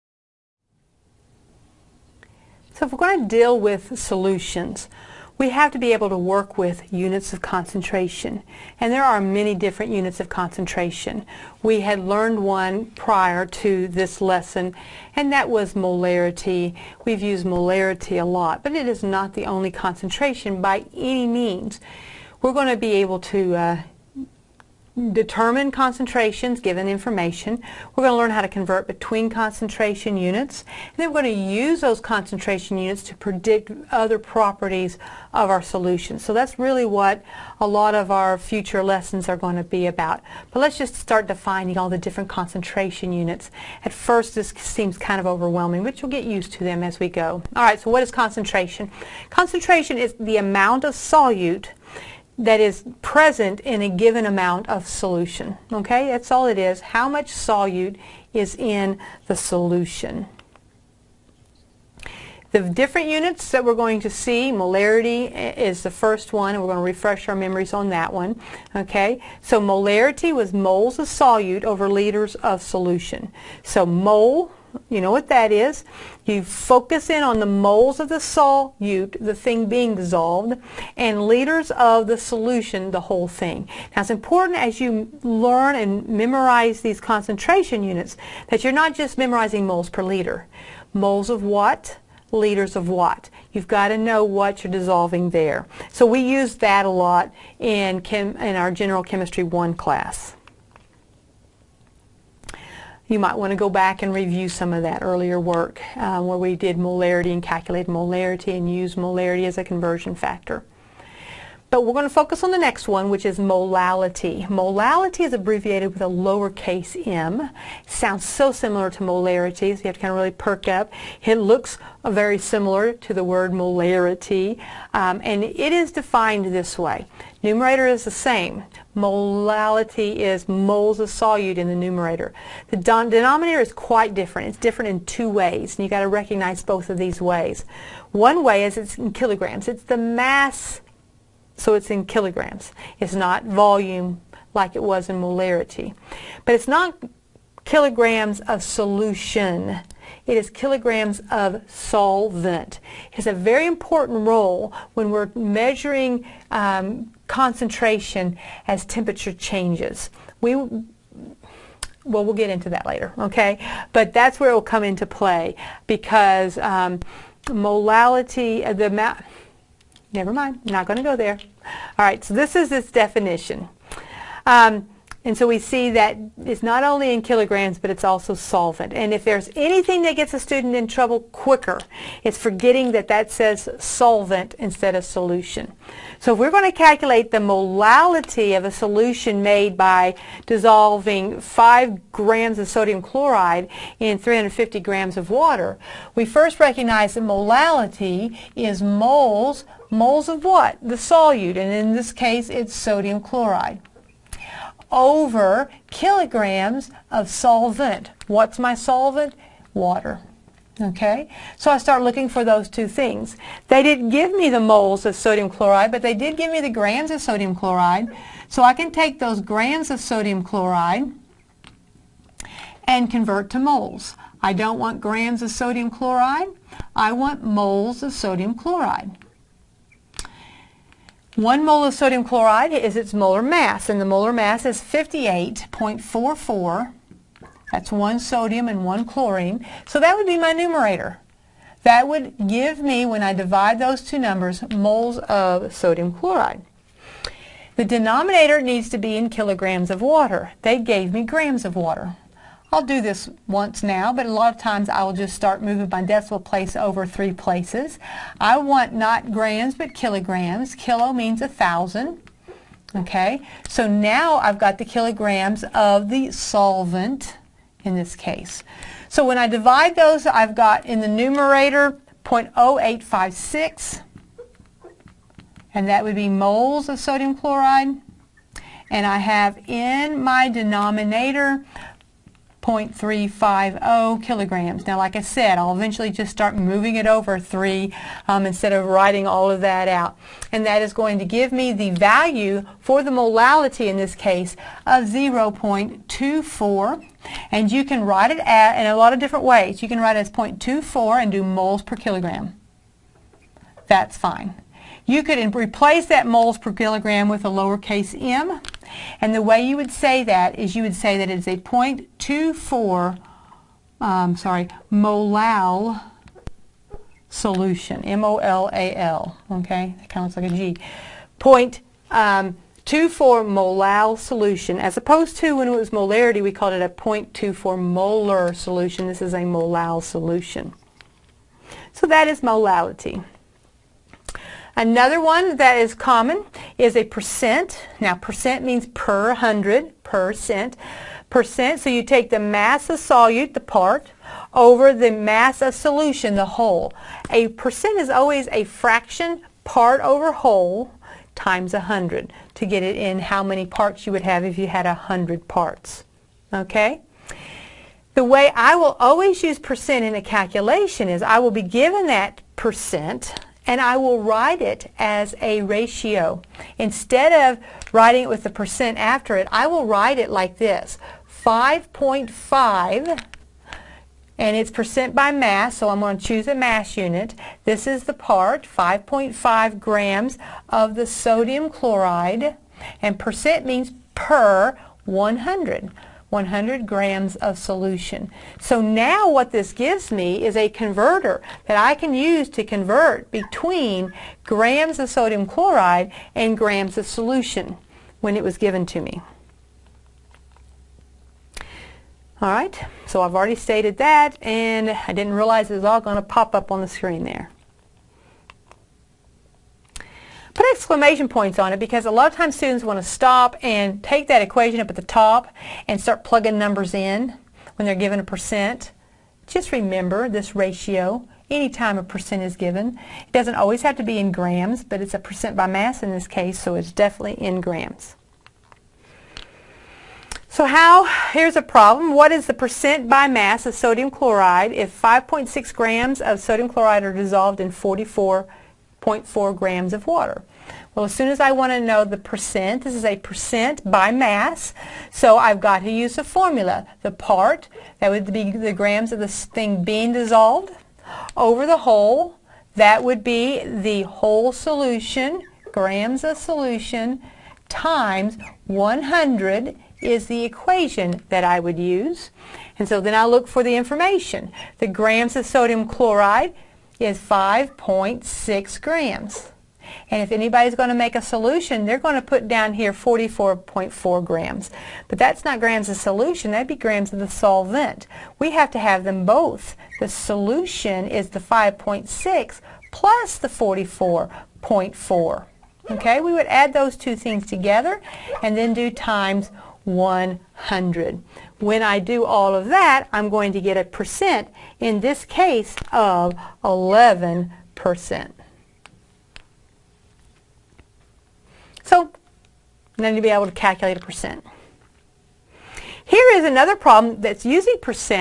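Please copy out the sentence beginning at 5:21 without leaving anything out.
Point, um, 0.24 molal solution as opposed to when it was molarity we called it a 0.24 molar solution.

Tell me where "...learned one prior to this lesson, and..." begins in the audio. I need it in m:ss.
0:11.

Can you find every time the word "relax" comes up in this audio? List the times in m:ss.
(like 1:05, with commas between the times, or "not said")
not said.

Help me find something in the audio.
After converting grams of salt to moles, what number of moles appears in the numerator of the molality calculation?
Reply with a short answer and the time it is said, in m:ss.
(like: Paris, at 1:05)
0.0856, at 4:32.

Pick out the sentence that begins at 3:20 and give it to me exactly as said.
The solute, and in this case it's sodium chloride.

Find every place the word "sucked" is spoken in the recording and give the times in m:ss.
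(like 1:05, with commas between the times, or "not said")
not said.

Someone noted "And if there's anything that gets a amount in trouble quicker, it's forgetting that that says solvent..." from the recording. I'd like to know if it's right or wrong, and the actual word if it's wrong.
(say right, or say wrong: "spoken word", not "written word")
wrong: "student", not "amount".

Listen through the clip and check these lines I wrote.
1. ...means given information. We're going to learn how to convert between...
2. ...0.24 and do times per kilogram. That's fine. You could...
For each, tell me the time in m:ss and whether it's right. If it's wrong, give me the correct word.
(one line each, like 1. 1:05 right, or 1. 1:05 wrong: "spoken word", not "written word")
1. 0:25 wrong: "concentrations", not "means"
2. 5:00 wrong: "moles", not "times".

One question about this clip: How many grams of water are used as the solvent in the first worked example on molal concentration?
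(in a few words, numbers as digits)
350 grams.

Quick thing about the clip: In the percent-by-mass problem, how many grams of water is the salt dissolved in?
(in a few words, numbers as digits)
44.4 grams.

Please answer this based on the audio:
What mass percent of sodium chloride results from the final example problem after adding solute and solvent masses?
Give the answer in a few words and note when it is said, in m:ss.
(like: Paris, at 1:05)
11%, at 8:16.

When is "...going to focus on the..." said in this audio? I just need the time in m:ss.
1:51.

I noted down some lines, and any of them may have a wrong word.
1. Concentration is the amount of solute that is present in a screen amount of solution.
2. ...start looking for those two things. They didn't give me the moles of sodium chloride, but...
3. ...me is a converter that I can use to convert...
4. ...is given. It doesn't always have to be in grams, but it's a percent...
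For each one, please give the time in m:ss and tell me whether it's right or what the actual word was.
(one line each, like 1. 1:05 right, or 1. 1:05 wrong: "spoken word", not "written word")
1. 0:49 wrong: "given", not "screen"
2. 3:31 right
3. 6:30 right
4. 7:02 right.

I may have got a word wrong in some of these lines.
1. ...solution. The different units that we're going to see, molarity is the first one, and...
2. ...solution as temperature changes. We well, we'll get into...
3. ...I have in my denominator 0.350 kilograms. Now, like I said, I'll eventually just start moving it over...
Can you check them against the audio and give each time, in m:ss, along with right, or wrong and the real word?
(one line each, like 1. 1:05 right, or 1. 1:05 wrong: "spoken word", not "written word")
1. 0:59 right
2. 2:37 wrong: "concentration", not "solution"
3. 4:39 right.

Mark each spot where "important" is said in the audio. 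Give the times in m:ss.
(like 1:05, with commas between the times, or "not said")
1:24, 2:33.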